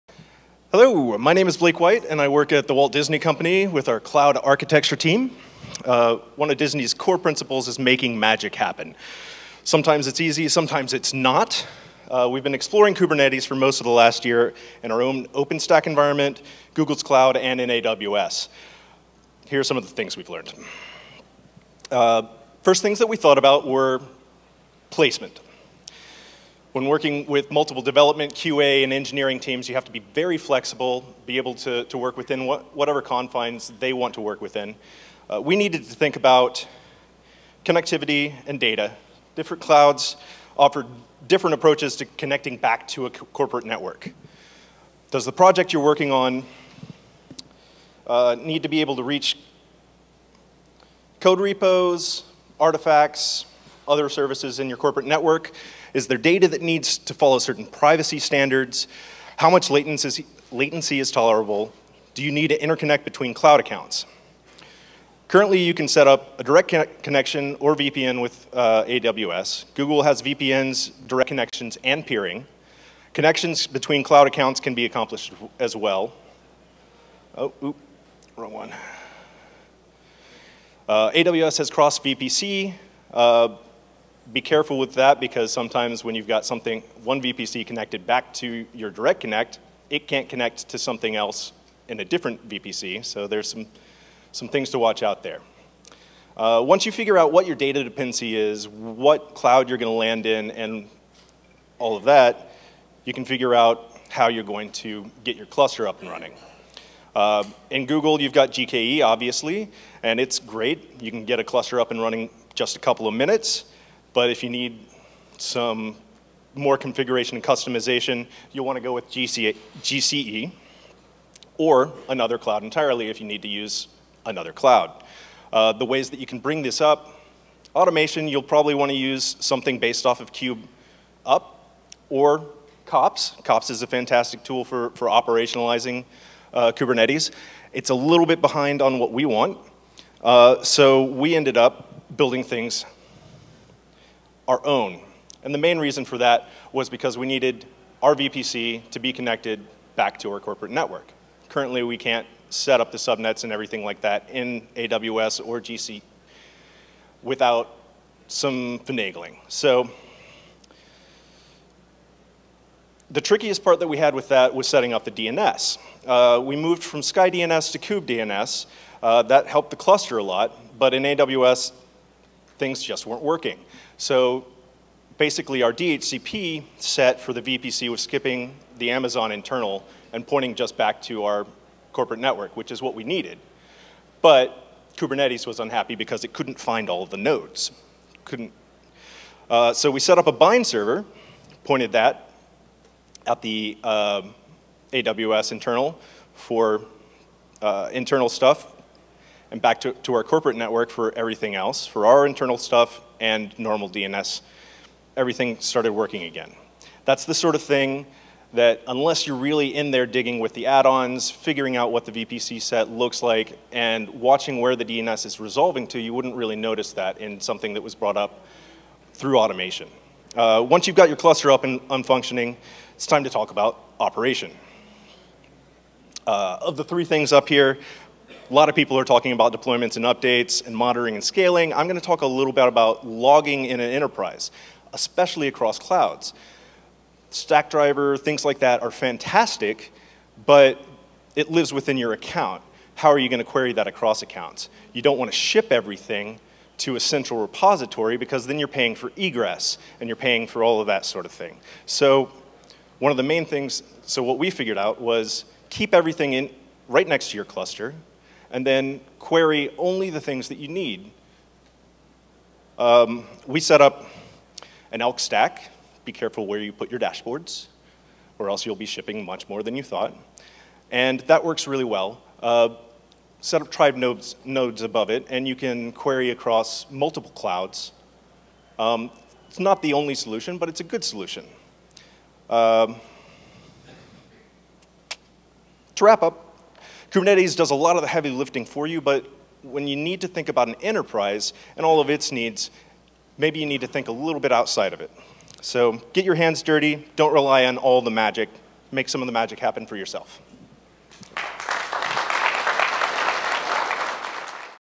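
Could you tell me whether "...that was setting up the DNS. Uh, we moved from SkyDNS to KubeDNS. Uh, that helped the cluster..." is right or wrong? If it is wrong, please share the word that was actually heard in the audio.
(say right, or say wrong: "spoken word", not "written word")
right.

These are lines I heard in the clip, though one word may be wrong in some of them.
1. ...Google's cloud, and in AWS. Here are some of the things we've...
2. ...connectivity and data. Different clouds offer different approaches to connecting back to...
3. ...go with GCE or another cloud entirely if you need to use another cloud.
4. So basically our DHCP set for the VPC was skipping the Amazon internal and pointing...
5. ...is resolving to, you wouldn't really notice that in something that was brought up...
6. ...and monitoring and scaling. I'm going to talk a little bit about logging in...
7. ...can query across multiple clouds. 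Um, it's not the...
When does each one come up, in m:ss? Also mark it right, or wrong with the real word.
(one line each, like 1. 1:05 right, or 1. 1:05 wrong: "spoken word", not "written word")
1. 0:16 right
2. 0:37 right
3. 1:58 right
4. 2:53 right
5. 3:35 right
6. 3:50 right
7. 4:35 right.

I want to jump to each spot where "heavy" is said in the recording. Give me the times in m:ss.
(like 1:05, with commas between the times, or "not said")
4:48.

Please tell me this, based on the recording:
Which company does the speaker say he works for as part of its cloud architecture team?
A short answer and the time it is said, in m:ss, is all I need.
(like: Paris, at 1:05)
Walt Disney Company, at 0:02.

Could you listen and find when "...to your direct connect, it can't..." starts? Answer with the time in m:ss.
1:28.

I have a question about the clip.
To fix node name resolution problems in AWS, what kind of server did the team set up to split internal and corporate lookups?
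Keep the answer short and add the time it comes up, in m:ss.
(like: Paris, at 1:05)
bind server, at 3:10.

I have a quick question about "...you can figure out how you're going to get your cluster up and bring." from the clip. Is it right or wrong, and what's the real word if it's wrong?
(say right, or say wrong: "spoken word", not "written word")
wrong: "running", not "bring".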